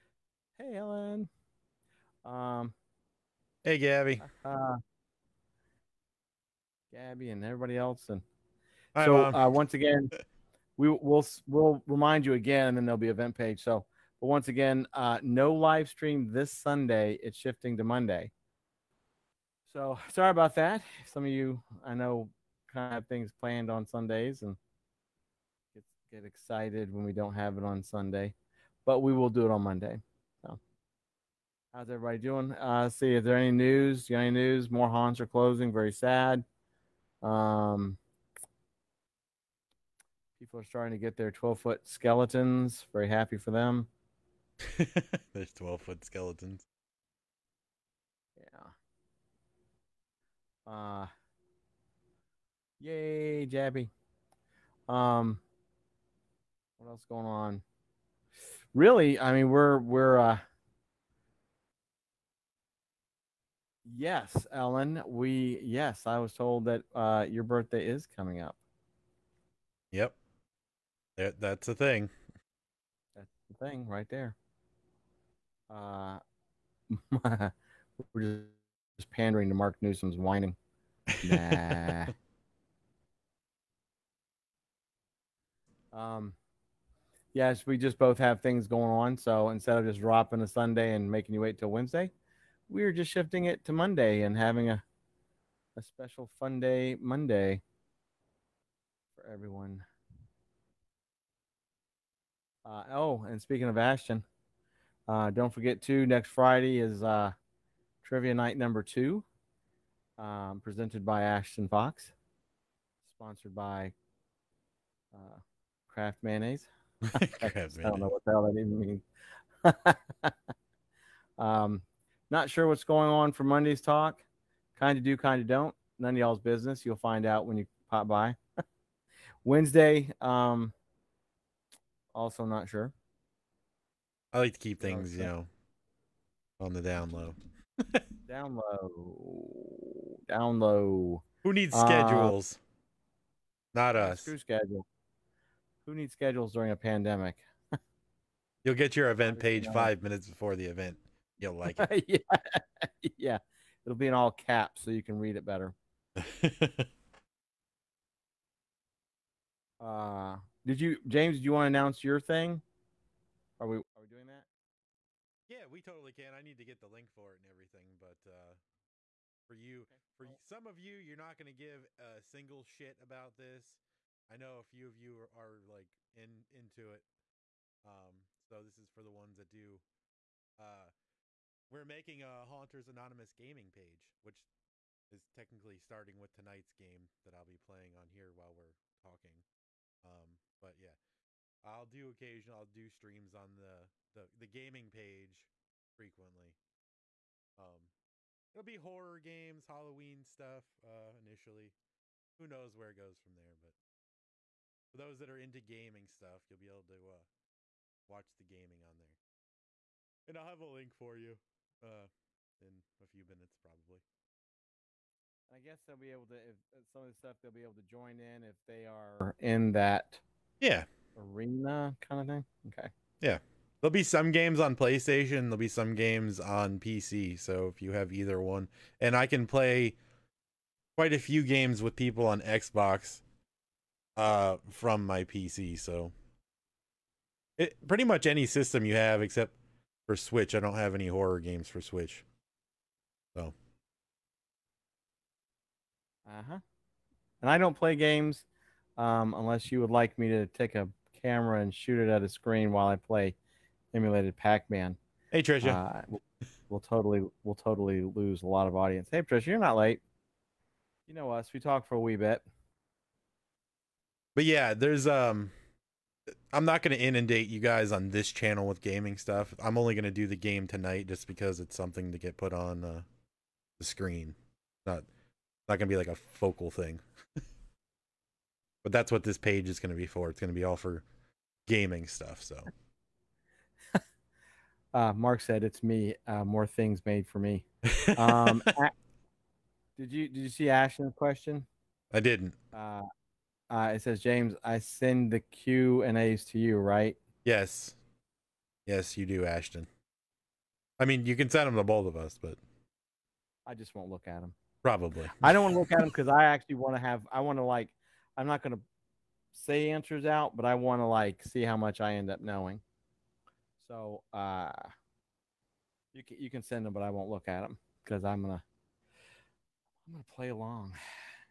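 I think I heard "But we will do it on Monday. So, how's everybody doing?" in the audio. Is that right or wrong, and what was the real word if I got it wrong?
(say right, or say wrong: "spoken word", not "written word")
right.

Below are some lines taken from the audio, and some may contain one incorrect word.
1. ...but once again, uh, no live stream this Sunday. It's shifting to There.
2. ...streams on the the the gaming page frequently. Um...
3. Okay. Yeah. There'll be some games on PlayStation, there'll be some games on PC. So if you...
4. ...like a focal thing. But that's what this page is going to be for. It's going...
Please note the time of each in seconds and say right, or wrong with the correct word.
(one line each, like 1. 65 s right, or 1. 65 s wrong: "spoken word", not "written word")
1. 14 s wrong: "Monday", not "There"
2. 192 s right
3. 222 s right
4. 275 s right.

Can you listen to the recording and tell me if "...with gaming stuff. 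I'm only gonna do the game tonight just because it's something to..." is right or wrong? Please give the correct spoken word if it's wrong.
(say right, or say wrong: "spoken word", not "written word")
right.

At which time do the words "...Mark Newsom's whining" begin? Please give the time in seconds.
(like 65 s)
79 s.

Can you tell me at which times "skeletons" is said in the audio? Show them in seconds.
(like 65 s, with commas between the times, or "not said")
41 s, 46 s.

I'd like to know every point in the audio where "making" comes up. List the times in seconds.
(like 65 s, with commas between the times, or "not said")
91 s, 181 s.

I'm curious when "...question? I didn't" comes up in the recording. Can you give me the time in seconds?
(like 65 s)
291 s.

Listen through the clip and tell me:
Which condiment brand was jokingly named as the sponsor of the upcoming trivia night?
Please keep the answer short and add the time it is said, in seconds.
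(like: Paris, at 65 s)
Kraft Mayonnaise, at 115 s.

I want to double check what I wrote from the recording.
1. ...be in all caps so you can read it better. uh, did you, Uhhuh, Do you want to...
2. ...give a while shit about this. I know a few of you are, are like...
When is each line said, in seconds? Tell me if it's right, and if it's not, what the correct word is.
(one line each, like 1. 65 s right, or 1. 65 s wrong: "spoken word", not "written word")
1. 153 s wrong: "James", not "Uhhuh"
2. 171 s wrong: "single", not "while".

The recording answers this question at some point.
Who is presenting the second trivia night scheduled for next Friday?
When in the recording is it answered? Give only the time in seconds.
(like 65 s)
111 s.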